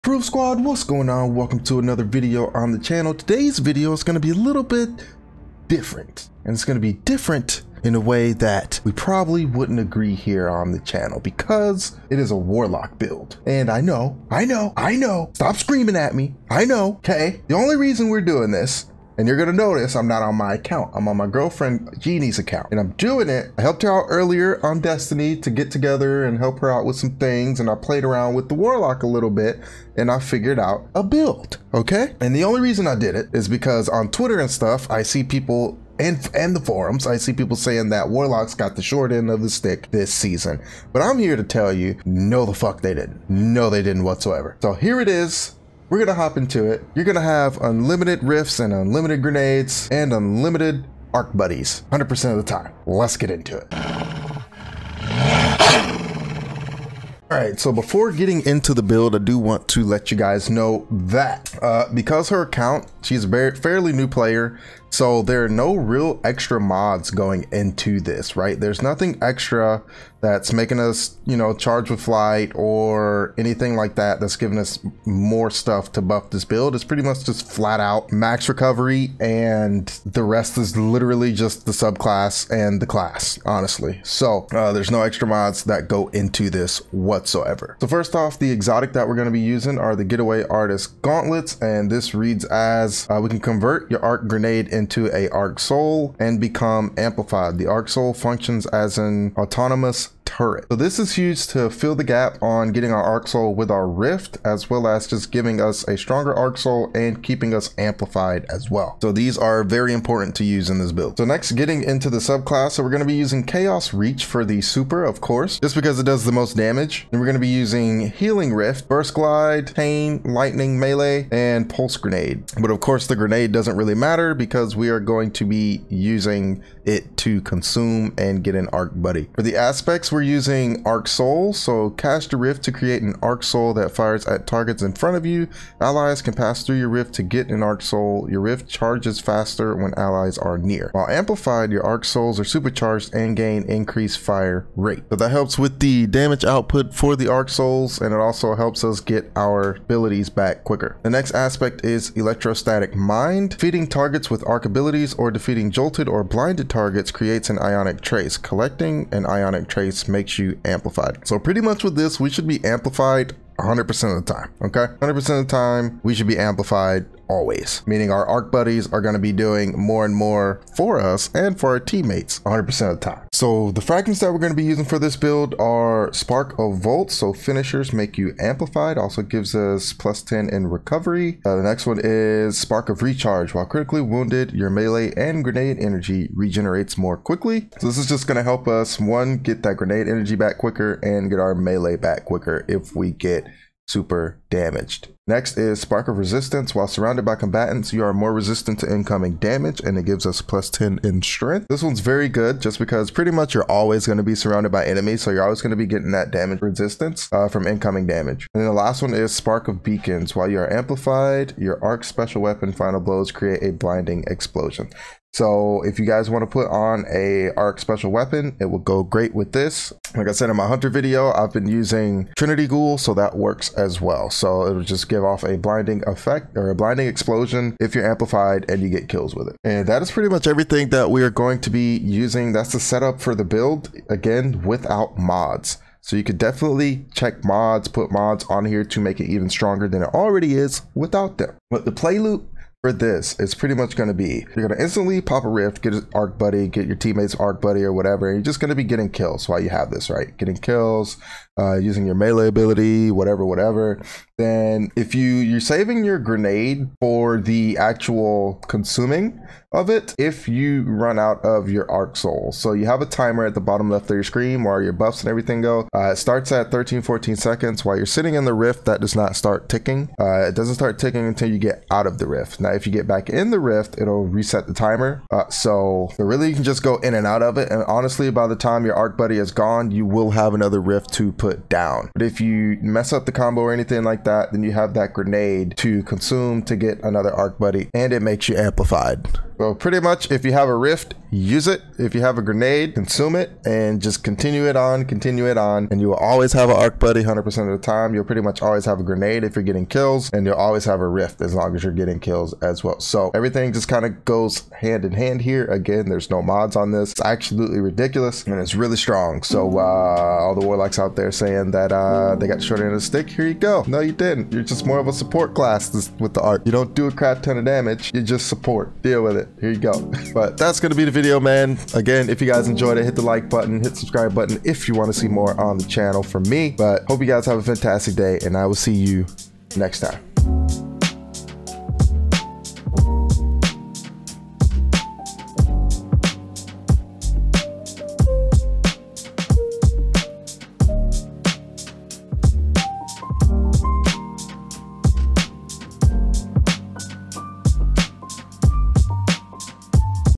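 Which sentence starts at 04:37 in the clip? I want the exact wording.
And honestly, by the time your arc buddy is gone, you will have another rift to put put down.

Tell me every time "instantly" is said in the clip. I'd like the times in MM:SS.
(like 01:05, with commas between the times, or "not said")
04:04.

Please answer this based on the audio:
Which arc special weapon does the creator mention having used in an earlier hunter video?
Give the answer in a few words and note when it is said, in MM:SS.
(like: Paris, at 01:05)
Trinity Ghoul, at 03:42.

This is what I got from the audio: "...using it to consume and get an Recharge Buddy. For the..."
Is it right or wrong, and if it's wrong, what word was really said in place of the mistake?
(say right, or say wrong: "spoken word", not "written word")
wrong: "Arc", not "Recharge".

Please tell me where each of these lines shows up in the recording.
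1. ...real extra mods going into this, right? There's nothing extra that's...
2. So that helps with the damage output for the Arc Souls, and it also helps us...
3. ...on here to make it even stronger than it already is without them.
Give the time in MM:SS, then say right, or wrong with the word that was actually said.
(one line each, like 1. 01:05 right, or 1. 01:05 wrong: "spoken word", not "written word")
1. 01:05 right
2. 02:25 right
3. 03:58 right.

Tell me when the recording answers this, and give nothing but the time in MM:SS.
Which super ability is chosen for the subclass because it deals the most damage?
01:53.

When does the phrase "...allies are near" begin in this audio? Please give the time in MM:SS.
02:19.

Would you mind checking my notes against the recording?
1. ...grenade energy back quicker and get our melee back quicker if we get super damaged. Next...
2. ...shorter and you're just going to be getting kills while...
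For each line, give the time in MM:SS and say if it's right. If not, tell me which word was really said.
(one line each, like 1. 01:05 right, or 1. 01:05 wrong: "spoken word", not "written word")
1. 03:09 right
2. 04:07 wrong: "whatever", not "shorter".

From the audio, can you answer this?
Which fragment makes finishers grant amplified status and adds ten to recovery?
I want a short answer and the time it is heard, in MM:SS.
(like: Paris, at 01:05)
Spark of Volt, at 02:56.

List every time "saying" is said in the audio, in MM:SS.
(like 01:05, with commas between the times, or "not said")
00:37, 05:11.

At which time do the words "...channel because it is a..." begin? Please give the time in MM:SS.
00:10.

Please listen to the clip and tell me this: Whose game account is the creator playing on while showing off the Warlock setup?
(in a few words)
Jeannie.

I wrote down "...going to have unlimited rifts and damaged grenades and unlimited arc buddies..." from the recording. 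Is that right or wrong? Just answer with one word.
wrong.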